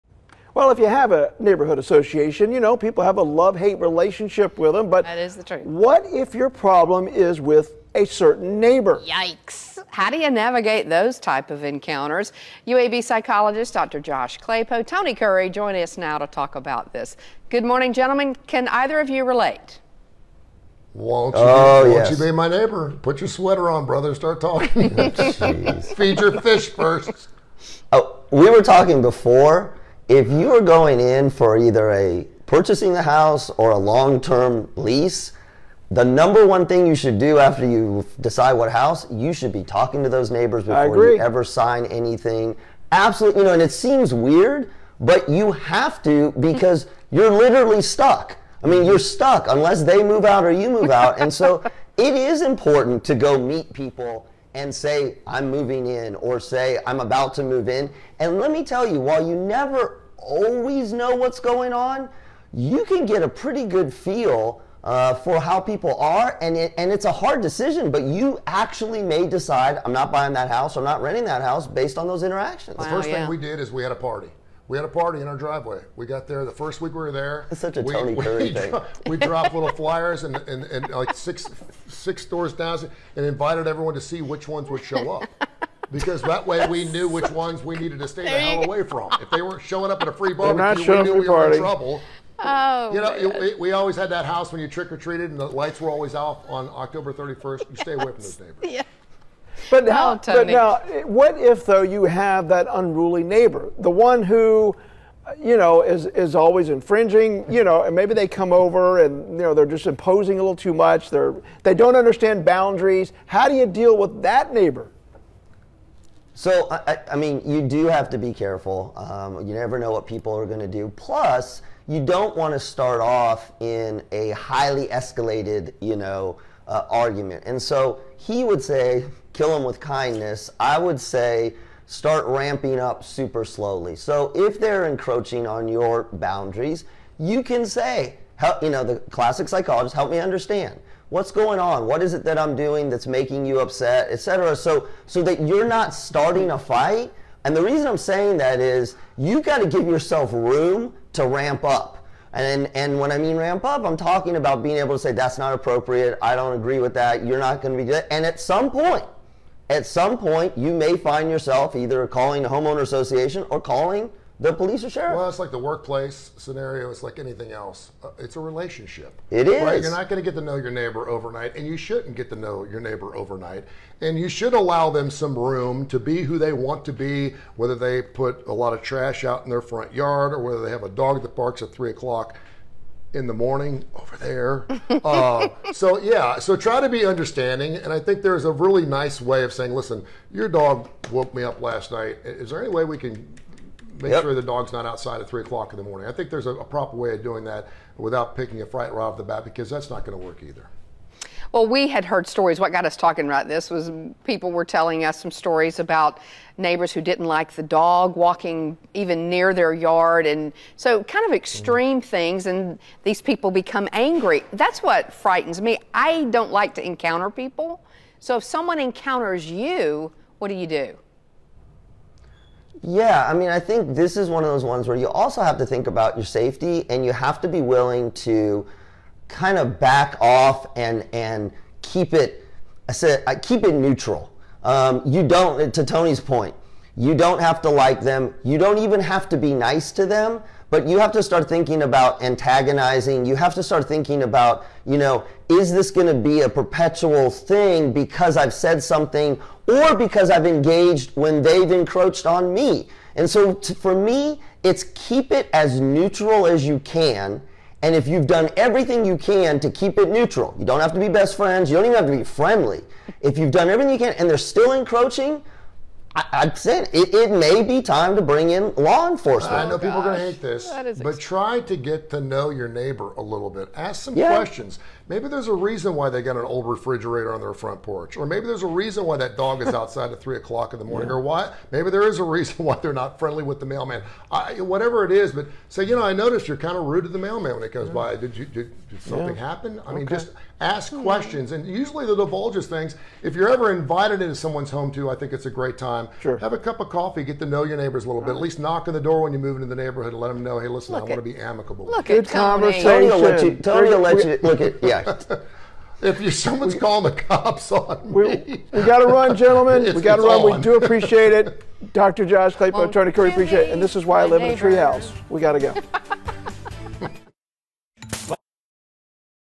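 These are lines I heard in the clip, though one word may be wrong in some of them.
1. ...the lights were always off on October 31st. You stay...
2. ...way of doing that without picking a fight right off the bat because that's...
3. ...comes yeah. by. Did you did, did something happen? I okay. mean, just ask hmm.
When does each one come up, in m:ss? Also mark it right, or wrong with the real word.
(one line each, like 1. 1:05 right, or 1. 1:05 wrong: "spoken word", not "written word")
1. 1:35 right
2. 3:16 right
3. 4:47 right.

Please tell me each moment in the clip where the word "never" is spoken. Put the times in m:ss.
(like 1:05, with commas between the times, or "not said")
0:59, 1:59.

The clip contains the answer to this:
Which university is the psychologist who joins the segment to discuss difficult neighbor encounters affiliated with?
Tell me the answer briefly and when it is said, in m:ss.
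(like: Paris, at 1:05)
UAB, at 0:12.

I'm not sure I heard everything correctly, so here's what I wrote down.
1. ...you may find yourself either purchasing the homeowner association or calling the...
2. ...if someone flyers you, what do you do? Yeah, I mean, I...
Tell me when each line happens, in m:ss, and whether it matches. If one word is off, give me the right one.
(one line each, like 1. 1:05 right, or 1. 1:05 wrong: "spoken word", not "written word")
1. 2:40 wrong: "calling", not "purchasing"
2. 3:38 wrong: "encounters", not "flyers".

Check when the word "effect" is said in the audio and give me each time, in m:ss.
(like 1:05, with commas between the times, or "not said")
not said.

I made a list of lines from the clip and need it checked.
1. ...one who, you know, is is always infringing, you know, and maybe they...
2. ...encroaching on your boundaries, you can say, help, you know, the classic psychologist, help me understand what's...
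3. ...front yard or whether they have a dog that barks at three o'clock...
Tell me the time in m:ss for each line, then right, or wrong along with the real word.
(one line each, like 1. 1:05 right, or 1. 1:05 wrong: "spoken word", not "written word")
1. 1:43 right
2. 2:14 right
3. 2:59 right.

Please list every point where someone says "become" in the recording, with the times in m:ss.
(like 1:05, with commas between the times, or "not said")
3:33.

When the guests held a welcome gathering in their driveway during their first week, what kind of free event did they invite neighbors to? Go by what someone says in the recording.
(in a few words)
barbecue.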